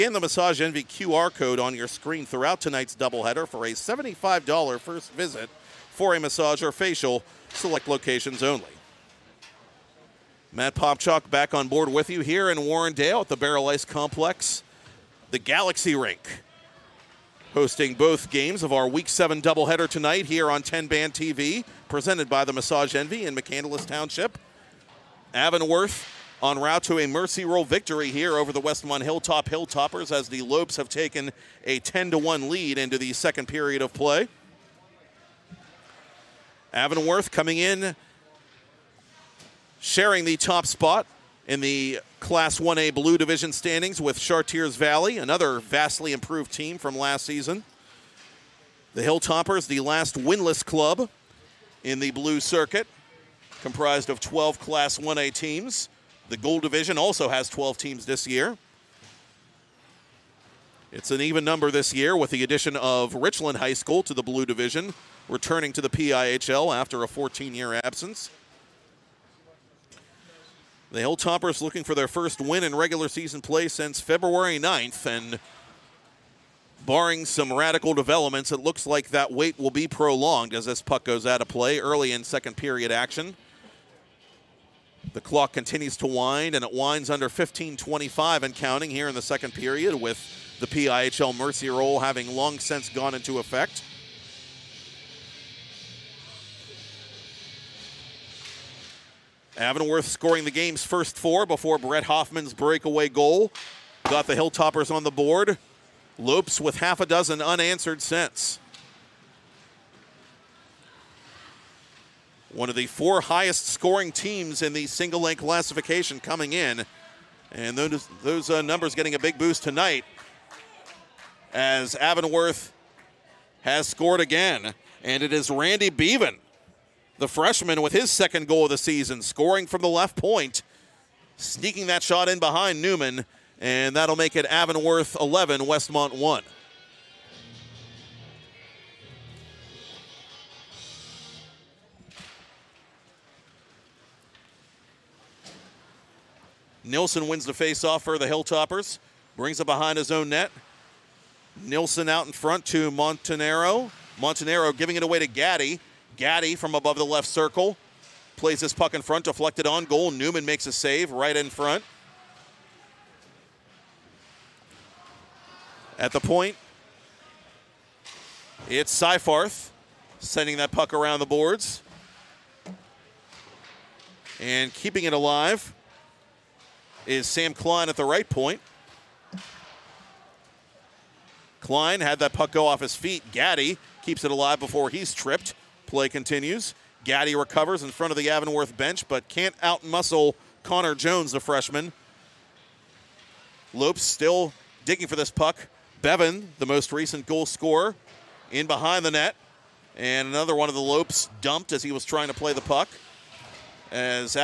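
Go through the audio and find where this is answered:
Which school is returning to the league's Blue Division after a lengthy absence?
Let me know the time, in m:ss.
1:03.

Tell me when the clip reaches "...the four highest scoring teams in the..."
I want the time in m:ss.
1:52.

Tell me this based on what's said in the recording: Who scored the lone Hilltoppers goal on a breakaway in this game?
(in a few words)
Brett Hoffman.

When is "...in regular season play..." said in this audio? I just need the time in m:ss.
1:12.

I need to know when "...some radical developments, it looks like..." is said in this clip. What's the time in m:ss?
1:17.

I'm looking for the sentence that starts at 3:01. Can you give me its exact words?
Klein had that puck go off his feet.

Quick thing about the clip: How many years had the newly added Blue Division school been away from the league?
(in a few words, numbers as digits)
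14.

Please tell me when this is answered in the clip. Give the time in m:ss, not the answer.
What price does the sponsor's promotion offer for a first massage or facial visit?
0:03.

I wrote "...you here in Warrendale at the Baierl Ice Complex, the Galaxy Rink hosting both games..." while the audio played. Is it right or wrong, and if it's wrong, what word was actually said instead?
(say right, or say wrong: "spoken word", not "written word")
right.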